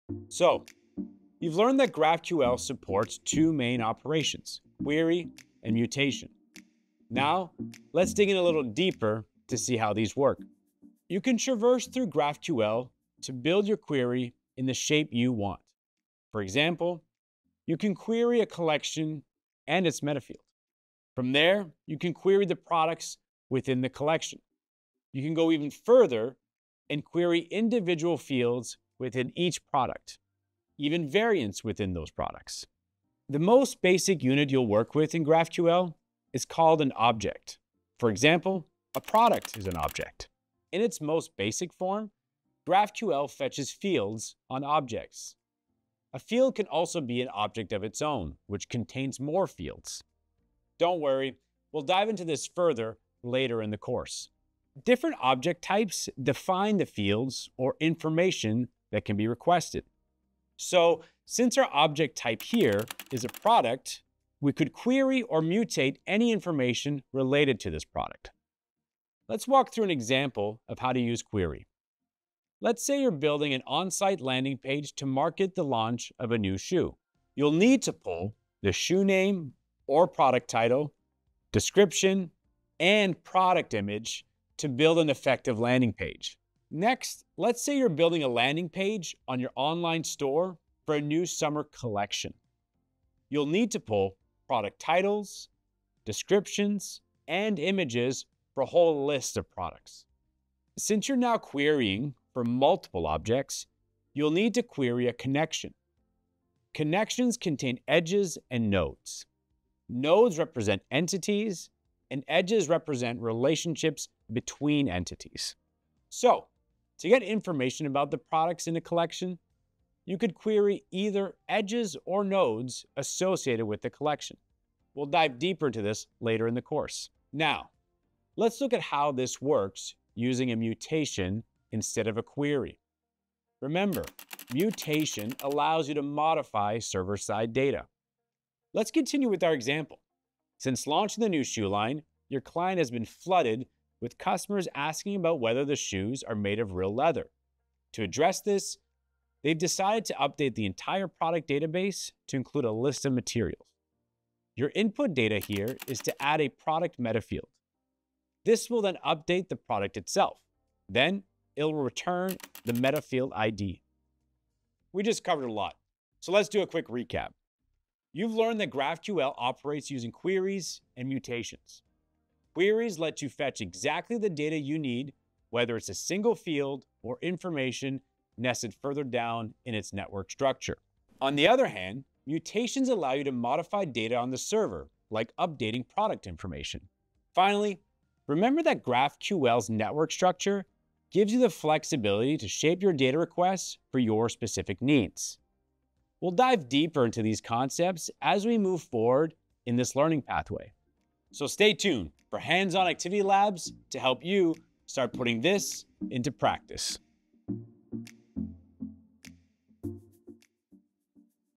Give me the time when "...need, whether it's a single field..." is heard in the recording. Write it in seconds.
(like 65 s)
174 s.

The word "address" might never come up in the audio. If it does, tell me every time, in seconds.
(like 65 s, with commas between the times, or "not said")
148 s.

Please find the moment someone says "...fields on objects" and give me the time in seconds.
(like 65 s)
43 s.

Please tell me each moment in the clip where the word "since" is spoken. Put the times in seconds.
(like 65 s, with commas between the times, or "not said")
61 s, 100 s, 140 s.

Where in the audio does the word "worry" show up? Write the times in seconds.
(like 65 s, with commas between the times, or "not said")
51 s.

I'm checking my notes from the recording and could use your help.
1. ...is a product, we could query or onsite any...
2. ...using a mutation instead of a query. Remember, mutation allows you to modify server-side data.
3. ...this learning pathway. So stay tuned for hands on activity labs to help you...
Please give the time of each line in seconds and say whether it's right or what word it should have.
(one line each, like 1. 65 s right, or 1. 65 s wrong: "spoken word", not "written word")
1. 63 s wrong: "mutate", not "onsite"
2. 130 s right
3. 199 s right.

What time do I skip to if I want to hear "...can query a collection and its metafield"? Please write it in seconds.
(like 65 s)
17 s.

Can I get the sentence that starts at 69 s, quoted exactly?
Let's walk through an example of how to use query.